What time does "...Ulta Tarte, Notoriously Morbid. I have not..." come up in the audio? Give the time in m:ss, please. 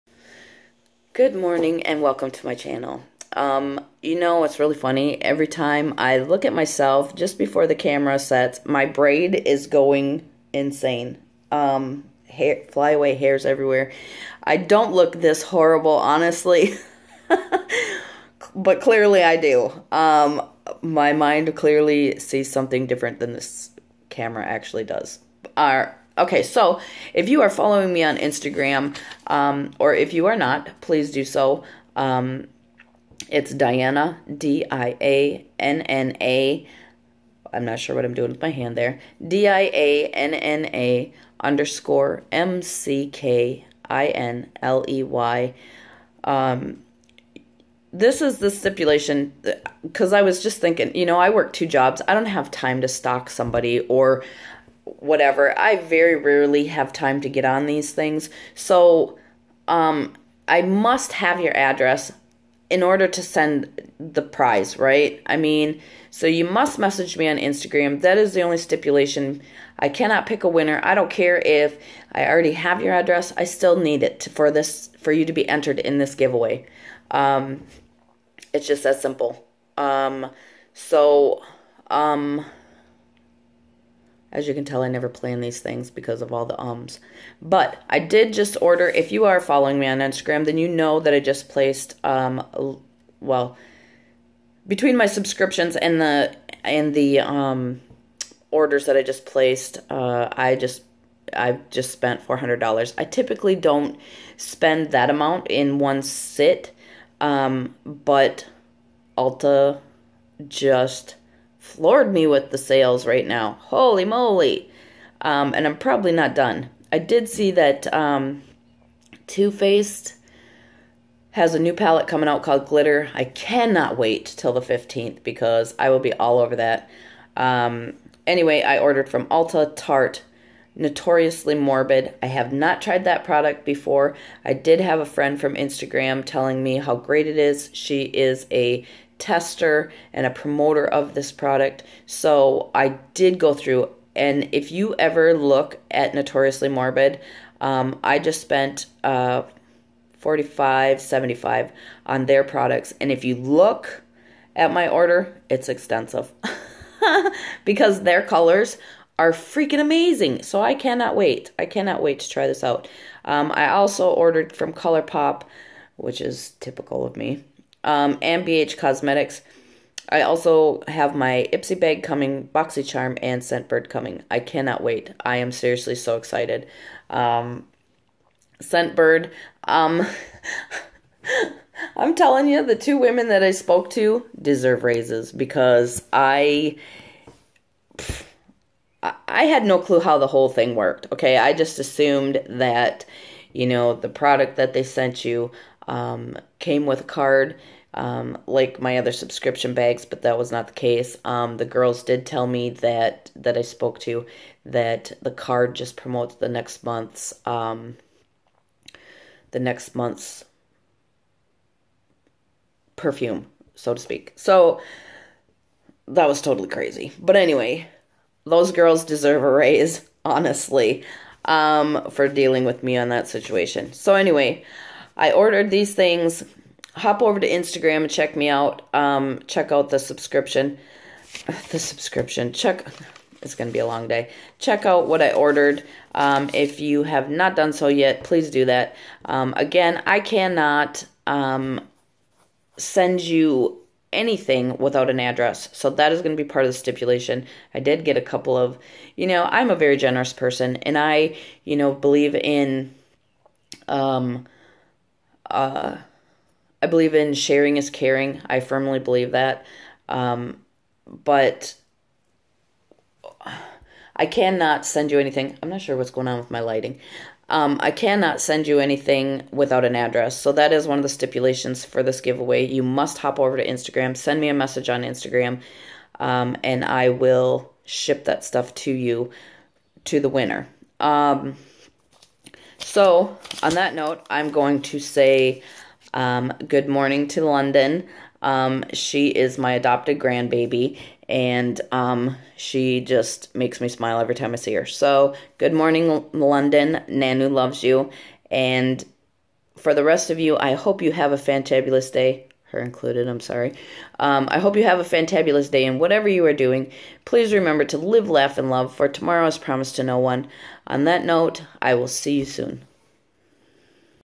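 2:09.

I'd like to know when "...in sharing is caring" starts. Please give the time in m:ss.
4:17.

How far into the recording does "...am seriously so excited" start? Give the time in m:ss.
2:55.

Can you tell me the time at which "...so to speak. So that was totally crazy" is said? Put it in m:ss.
3:33.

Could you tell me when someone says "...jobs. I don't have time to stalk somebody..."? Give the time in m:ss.
0:51.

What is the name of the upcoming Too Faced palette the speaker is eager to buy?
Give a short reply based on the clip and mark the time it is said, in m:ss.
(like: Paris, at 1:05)
Glitter, at 2:02.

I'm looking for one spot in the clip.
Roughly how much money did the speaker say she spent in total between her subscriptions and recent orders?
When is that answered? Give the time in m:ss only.
1:42.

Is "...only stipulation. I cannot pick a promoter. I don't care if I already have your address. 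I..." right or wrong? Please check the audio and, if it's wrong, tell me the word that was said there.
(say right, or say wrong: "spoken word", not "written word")
wrong: "winner", not "promoter".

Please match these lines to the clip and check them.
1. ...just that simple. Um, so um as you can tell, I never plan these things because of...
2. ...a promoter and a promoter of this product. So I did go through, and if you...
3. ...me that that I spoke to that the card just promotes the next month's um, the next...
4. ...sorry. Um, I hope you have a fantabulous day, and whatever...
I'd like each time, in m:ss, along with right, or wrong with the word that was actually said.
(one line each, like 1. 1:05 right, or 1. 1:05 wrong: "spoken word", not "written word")
1. 1:18 right
2. 2:18 wrong: "tester", not "promoter"
3. 3:22 right
4. 5:03 right.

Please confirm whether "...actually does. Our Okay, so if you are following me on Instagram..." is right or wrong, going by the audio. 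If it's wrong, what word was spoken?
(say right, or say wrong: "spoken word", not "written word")
right.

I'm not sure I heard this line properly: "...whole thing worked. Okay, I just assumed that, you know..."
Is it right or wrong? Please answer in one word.
right.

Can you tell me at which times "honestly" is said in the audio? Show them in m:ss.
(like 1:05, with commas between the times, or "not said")
0:15, 3:40.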